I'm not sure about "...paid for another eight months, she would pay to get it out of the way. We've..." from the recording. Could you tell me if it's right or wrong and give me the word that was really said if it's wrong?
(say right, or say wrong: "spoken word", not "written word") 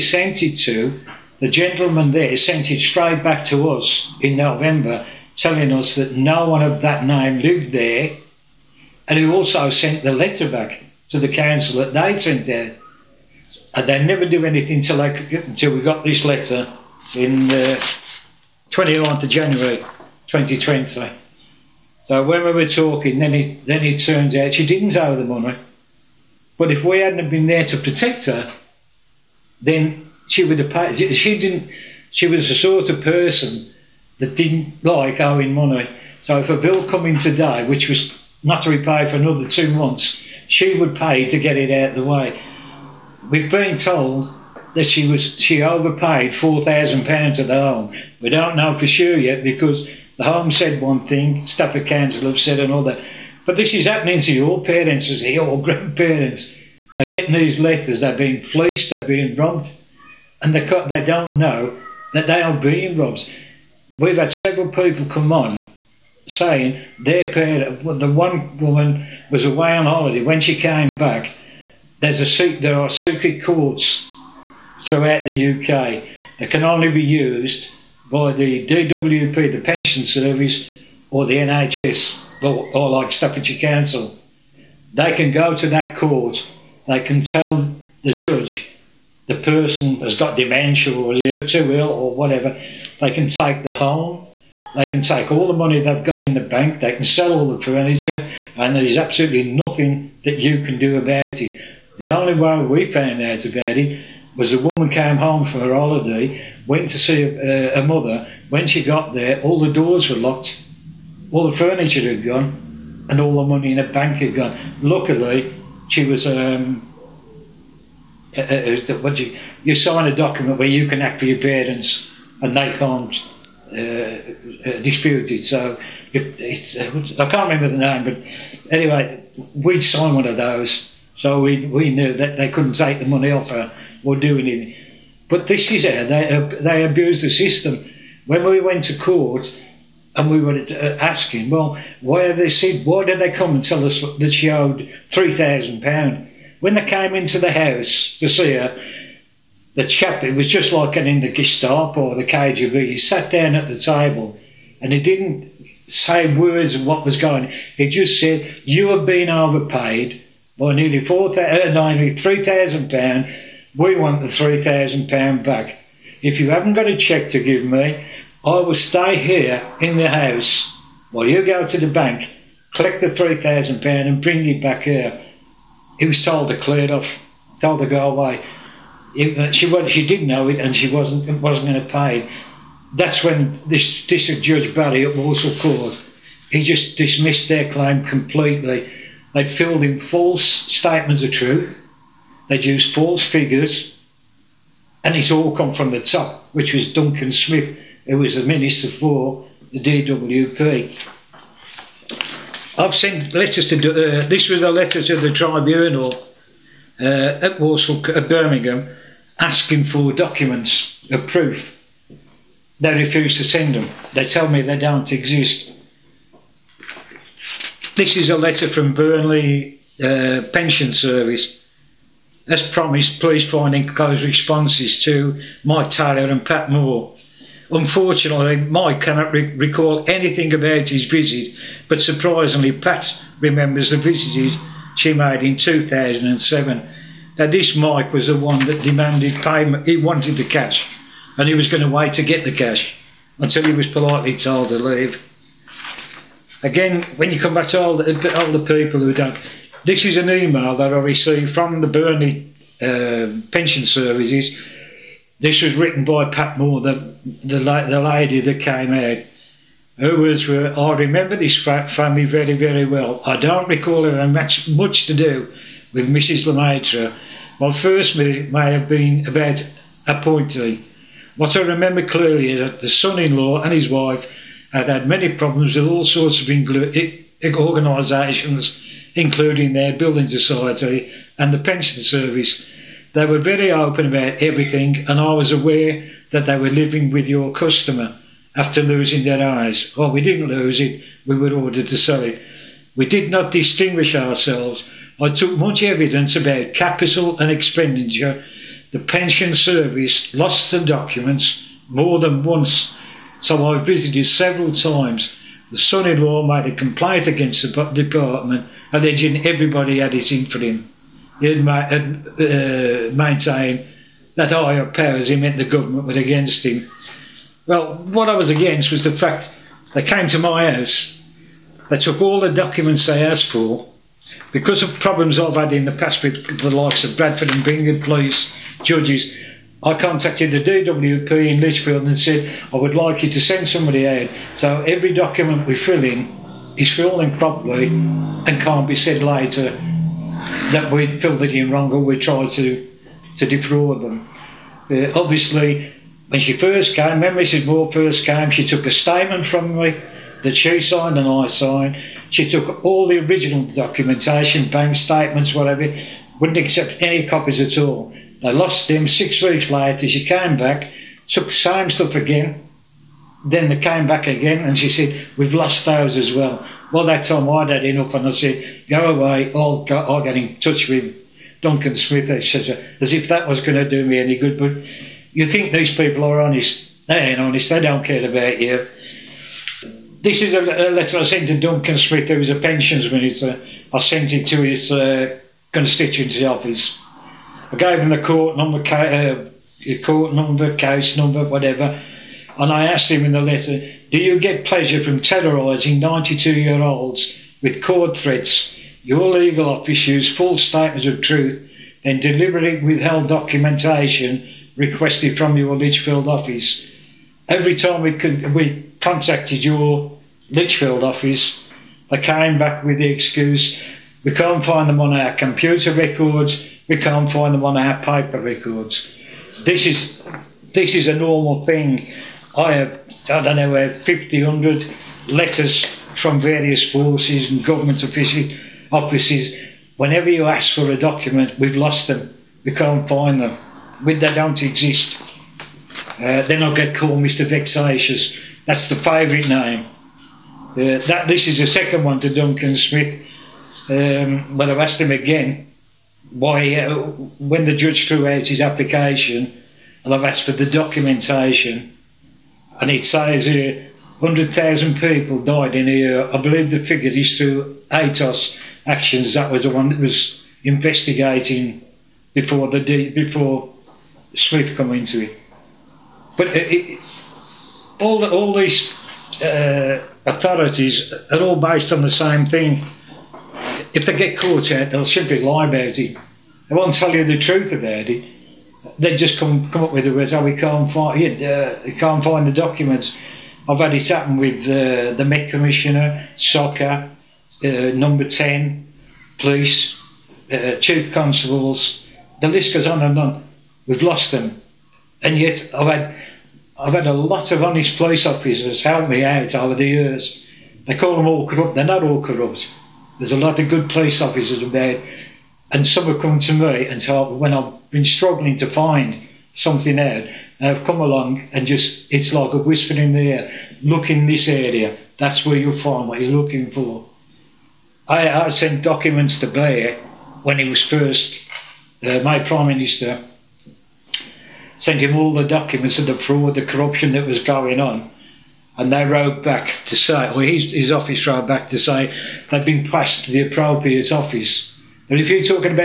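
wrong: "two", not "eight".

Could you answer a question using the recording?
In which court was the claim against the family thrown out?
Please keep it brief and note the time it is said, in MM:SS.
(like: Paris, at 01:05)
Walsall Court, at 03:05.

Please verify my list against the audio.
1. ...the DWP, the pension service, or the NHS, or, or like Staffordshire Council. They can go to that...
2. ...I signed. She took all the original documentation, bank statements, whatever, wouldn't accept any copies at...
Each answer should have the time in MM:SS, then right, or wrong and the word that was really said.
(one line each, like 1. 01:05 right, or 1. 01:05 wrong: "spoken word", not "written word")
1. 01:18 right
2. 05:51 right.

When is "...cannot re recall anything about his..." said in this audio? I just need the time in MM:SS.
03:49.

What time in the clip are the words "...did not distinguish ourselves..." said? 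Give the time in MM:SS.
04:53.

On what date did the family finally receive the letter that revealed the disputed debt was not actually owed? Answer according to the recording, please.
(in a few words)
29th of January 2020.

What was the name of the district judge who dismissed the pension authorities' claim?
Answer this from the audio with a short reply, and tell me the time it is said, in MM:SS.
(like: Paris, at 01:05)
Barry, at 03:04.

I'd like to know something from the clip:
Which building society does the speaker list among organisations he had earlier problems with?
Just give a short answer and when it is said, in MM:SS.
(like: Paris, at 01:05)
Bradford and Bingley, at 05:27.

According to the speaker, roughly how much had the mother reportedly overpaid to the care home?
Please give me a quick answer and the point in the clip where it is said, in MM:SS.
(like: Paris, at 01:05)
£4,000, at 00:46.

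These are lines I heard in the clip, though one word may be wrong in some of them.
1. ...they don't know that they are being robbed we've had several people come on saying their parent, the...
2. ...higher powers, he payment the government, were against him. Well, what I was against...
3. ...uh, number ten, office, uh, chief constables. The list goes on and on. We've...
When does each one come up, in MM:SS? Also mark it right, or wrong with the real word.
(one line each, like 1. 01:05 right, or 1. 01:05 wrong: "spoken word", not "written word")
1. 01:00 right
2. 05:14 wrong: "meant", not "payment"
3. 08:07 wrong: "police", not "office".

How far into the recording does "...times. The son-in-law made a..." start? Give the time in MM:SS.
05:04.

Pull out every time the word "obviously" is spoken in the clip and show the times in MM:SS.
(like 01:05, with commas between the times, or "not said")
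05:45.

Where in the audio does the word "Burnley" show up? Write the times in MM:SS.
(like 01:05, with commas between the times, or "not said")
03:38, 04:11.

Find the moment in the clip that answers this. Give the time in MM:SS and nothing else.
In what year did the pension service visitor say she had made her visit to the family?
03:55.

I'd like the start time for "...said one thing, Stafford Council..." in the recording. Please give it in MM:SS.
00:50.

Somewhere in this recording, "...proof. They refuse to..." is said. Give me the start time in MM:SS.
03:31.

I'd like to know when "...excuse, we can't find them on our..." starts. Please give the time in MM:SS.
06:53.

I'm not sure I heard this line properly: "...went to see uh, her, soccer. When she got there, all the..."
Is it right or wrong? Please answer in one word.
wrong.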